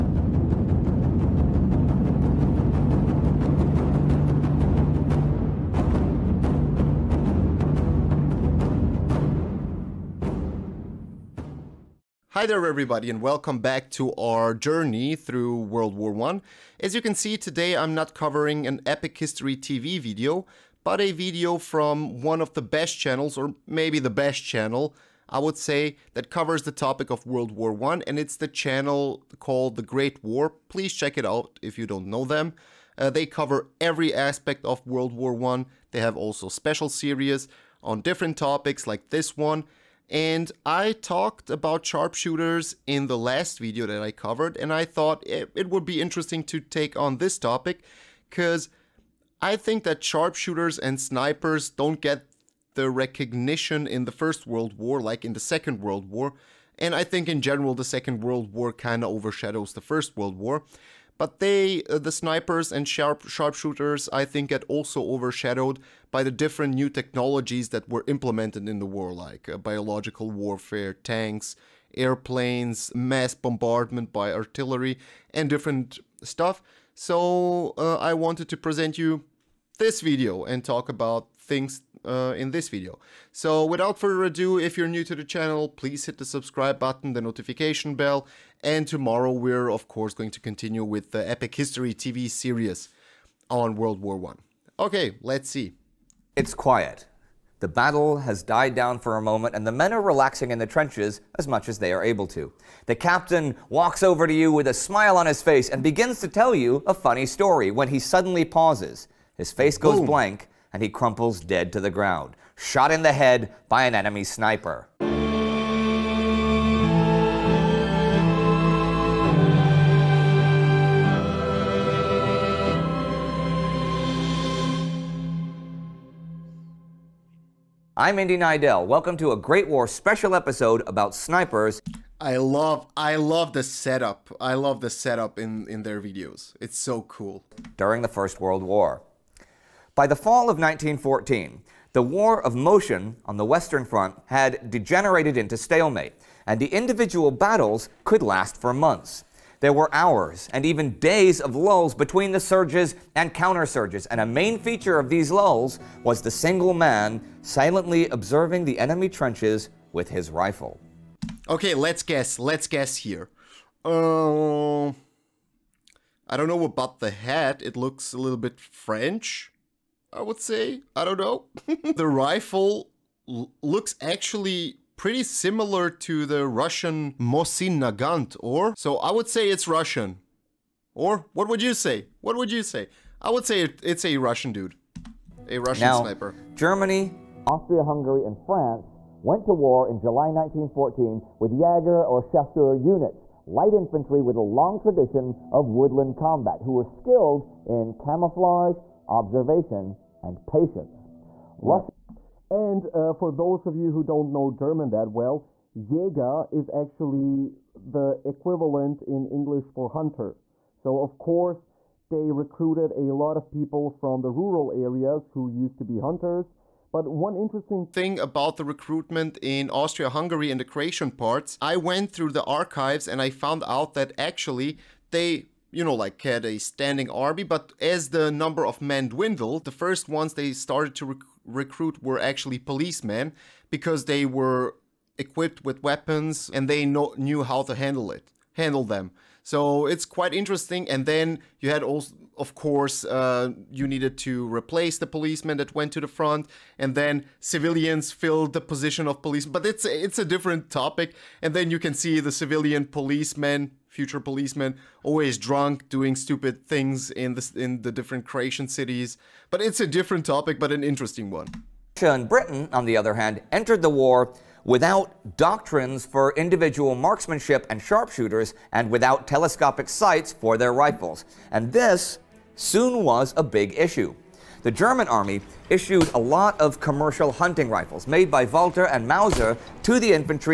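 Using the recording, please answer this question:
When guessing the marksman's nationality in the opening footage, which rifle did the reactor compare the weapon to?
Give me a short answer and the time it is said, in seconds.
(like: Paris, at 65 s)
Mosin Nagant, at 177 s.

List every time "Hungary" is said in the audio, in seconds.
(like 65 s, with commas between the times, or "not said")
187 s, 220 s.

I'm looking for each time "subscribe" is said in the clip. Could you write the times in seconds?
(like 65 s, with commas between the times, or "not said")
86 s.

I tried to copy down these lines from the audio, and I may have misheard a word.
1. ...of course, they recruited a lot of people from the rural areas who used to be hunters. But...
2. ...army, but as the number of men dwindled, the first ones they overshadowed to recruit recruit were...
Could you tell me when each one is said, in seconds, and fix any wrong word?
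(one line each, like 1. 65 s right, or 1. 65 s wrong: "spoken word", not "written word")
1. 211 s right
2. 227 s wrong: "started", not "overshadowed".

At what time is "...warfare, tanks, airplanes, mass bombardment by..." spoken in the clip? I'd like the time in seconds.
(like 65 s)
70 s.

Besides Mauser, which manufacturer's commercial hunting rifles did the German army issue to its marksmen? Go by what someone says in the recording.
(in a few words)
Walther.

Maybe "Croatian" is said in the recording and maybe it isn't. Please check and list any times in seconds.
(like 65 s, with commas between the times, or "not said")
220 s, 258 s.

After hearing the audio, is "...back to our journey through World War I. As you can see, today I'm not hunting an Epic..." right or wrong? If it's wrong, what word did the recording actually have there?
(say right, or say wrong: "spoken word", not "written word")
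wrong: "covering", not "hunting".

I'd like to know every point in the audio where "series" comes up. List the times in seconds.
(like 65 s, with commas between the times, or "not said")
36 s, 92 s.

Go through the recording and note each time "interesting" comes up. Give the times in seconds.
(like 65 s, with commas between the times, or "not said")
45 s, 217 s, 240 s, 260 s.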